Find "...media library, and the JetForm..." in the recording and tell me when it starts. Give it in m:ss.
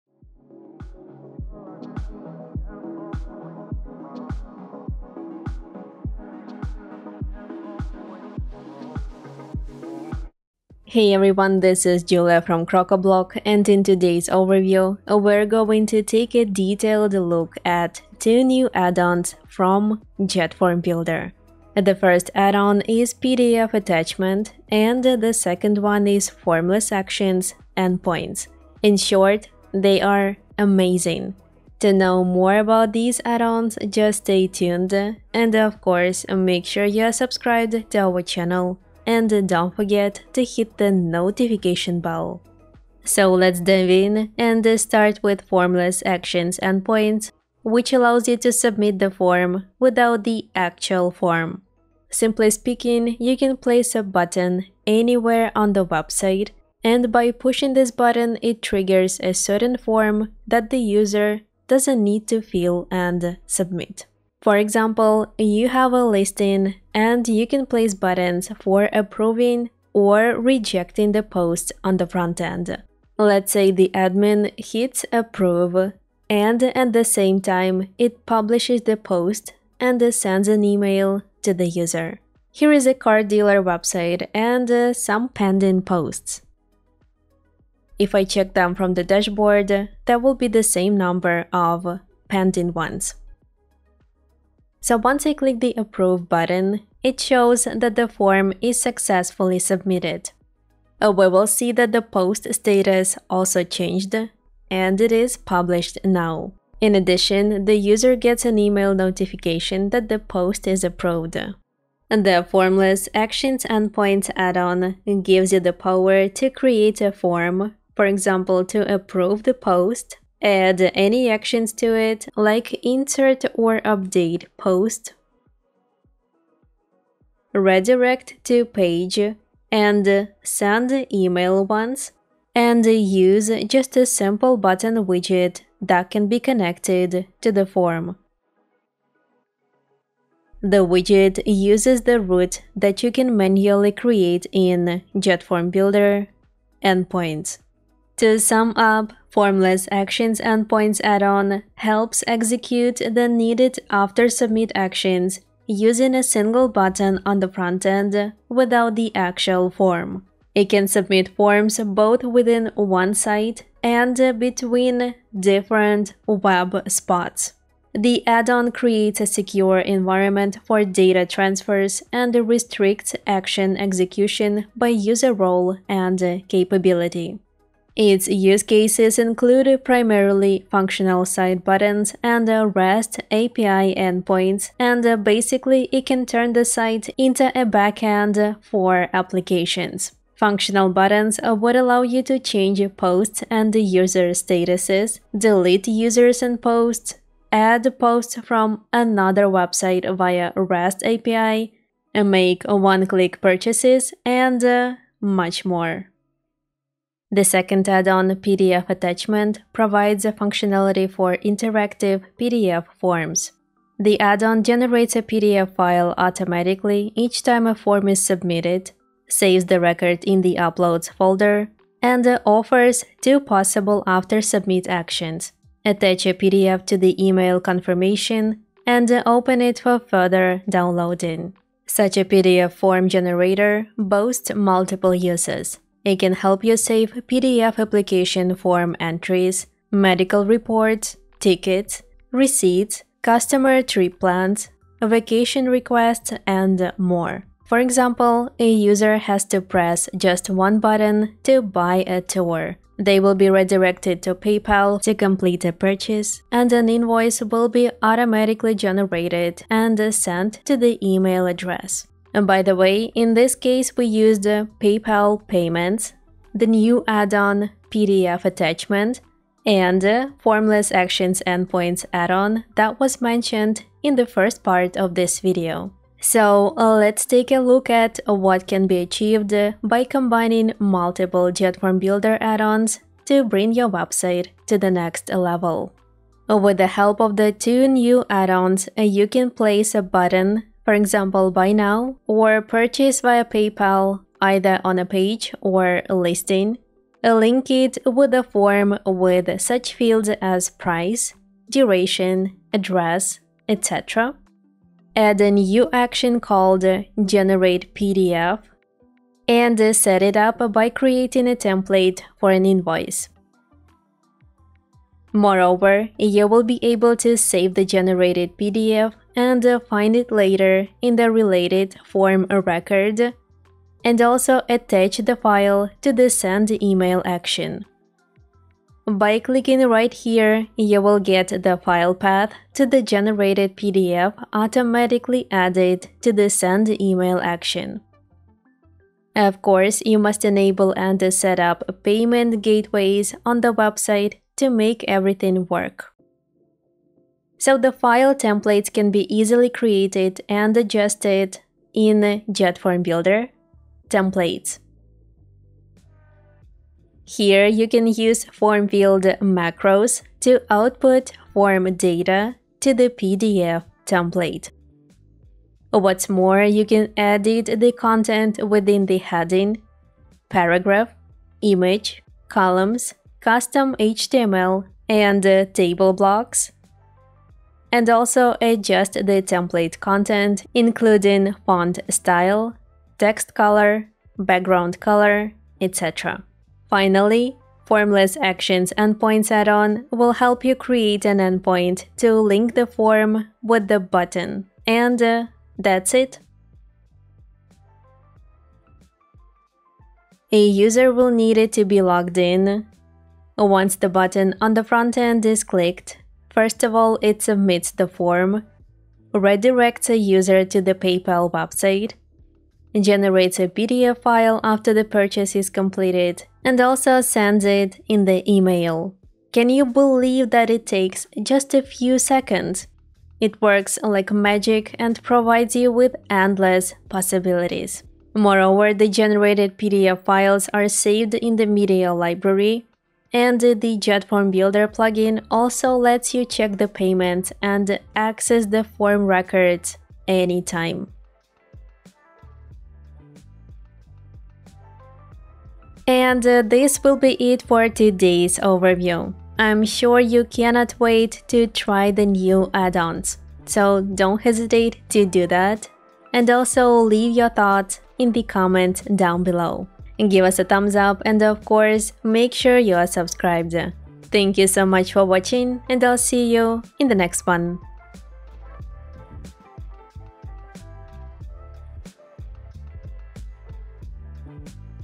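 7:11.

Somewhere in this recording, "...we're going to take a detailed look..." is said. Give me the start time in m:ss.
0:15.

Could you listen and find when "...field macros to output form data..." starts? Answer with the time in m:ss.
5:58.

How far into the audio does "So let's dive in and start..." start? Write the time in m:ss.
0:43.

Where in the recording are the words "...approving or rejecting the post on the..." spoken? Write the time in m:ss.
1:08.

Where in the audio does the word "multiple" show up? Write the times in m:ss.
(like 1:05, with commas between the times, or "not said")
3:54, 4:40.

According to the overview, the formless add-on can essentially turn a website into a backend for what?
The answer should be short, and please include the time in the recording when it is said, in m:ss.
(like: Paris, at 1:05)
applications, at 3:09.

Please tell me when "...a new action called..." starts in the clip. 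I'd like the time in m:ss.
5:05.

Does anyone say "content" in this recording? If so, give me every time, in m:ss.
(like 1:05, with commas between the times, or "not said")
6:07, 6:19.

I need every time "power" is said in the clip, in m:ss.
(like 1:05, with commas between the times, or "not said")
1:55.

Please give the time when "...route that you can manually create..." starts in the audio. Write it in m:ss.
2:22.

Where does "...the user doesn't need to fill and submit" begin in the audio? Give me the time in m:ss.
1:00.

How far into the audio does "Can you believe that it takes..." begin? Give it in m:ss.
6:59.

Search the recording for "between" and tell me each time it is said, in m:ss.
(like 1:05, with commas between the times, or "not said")
2:44.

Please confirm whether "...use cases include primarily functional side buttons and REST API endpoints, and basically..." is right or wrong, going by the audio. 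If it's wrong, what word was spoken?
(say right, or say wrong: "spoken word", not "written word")
right.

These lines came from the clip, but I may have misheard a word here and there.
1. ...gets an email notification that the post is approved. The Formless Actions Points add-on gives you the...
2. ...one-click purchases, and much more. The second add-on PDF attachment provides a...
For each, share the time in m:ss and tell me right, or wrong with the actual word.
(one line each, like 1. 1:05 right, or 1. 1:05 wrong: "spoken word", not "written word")
1. 1:48 right
2. 3:22 right.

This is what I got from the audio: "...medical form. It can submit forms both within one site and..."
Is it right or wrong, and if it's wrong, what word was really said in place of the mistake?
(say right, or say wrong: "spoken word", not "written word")
wrong: "actual", not "medical".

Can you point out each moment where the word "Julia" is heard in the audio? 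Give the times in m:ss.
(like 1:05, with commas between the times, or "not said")
0:12.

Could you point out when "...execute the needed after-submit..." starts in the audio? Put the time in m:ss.
2:32.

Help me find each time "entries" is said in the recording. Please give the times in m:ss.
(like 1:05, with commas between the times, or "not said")
3:58.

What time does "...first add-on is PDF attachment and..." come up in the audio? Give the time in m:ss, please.
0:21.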